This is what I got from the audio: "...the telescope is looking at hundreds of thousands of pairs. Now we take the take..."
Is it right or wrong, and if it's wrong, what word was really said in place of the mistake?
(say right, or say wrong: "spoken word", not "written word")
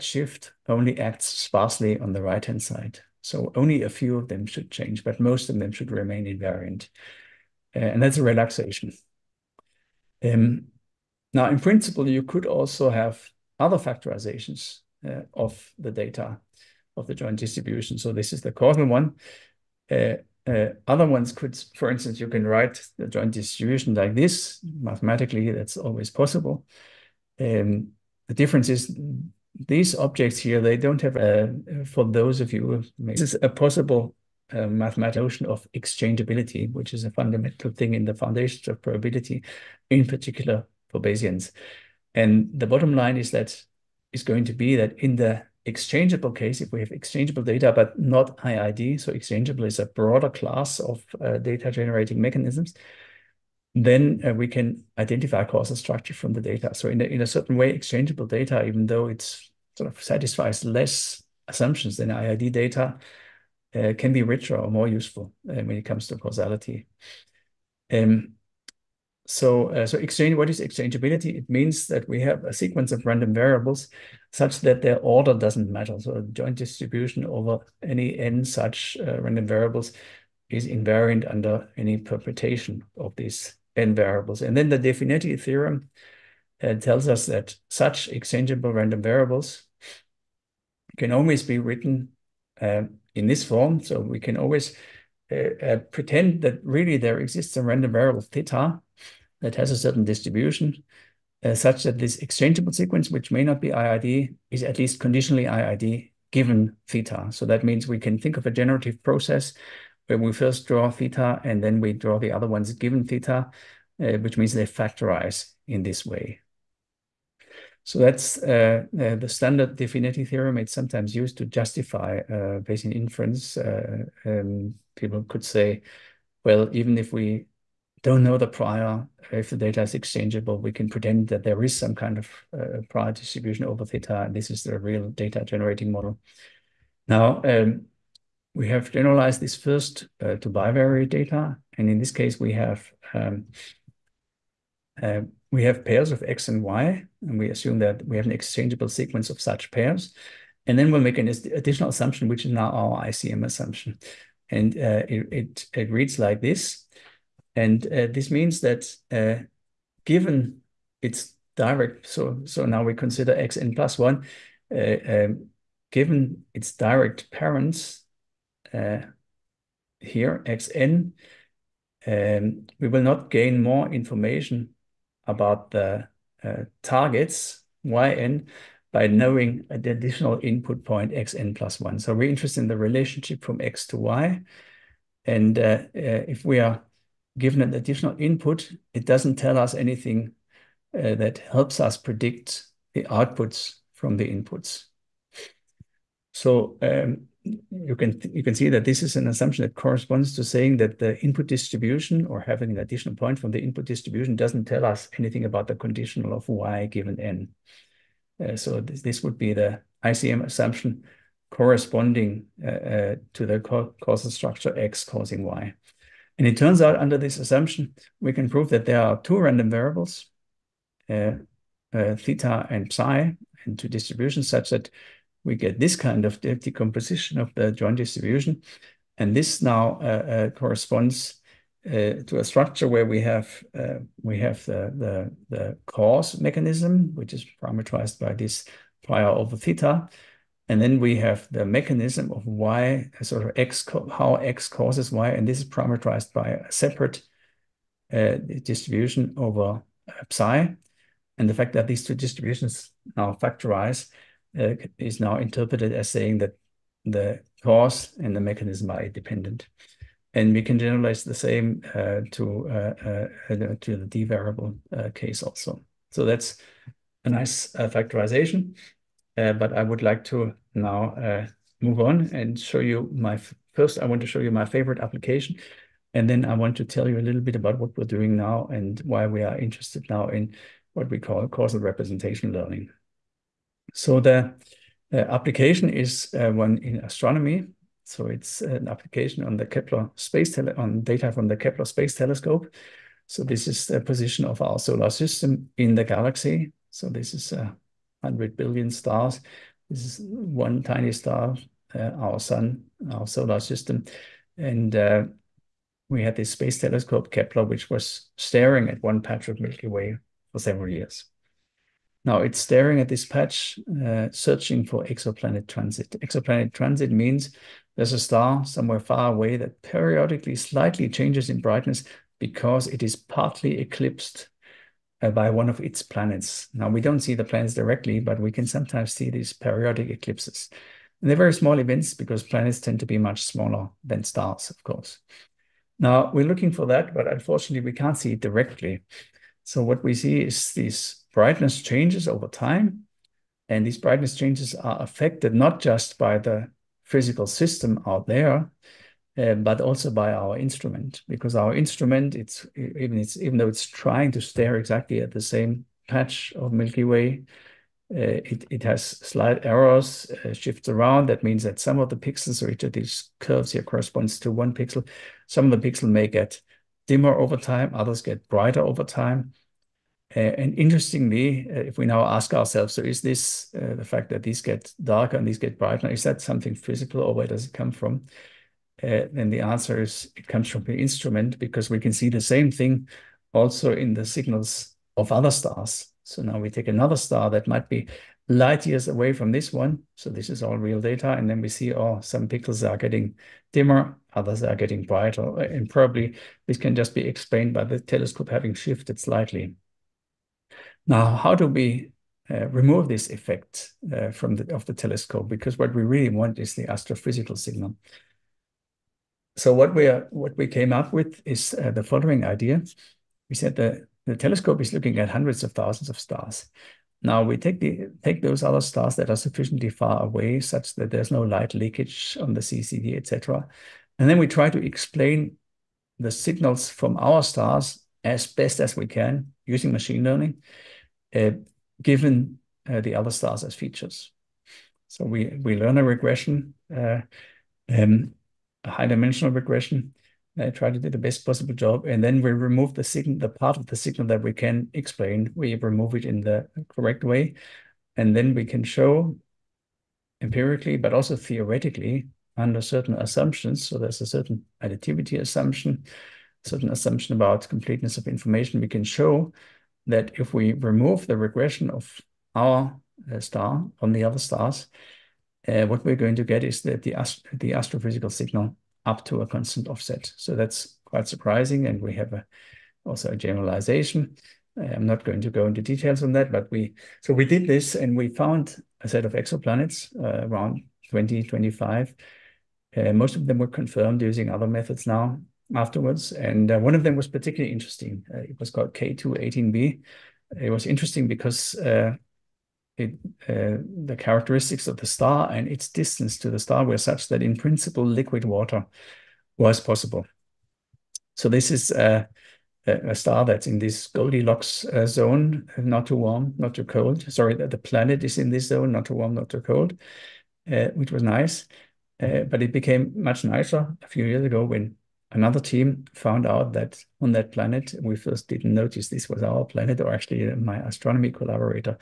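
wrong: "stars", not "pairs".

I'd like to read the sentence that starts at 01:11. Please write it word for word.
It means that we have a sequence of random variables such that their order doesn't matter.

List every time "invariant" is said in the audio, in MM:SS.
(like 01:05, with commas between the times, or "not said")
00:06, 01:20.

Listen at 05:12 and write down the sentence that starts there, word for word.
Now it's staring at this patch, uh, searching for exoplanet transit.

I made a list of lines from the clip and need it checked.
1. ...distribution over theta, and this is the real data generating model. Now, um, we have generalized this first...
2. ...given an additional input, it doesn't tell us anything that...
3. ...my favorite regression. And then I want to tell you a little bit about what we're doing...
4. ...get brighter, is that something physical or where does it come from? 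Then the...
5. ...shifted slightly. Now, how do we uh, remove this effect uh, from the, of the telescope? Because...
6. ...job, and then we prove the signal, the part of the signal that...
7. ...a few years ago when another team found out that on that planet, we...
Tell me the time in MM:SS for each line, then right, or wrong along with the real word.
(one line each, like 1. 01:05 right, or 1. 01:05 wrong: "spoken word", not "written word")
1. 02:13 right
2. 03:07 right
3. 04:34 wrong: "application", not "regression"
4. 06:15 right
5. 06:38 right
6. 07:21 wrong: "remove", not "prove"
7. 08:34 right.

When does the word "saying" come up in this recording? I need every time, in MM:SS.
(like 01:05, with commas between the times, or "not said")
03:20, 04:16.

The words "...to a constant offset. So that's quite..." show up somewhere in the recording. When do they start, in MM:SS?
07:49.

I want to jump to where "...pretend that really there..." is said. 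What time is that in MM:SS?
01:35.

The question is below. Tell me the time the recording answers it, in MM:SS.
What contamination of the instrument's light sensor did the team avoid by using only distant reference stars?
07:01.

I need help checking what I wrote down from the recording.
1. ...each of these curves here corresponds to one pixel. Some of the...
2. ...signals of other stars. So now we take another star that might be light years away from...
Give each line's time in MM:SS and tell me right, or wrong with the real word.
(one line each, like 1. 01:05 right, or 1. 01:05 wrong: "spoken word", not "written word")
1. 06:02 right
2. 06:24 right.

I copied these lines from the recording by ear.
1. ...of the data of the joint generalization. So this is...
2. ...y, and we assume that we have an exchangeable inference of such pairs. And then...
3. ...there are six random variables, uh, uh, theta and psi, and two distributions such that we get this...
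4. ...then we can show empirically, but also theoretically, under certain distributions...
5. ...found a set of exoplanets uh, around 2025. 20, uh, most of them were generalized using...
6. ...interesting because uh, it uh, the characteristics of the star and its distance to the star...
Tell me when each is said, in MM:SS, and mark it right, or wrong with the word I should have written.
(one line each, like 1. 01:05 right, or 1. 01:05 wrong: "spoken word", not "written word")
1. 00:15 wrong: "distribution", not "generalization"
2. 02:26 wrong: "sequence", not "inference"
3. 03:38 wrong: "two", not "six"
4. 07:28 wrong: "assumptions", not "distributions"
5. 07:58 wrong: "confirmed", not "generalized"
6. 08:10 right.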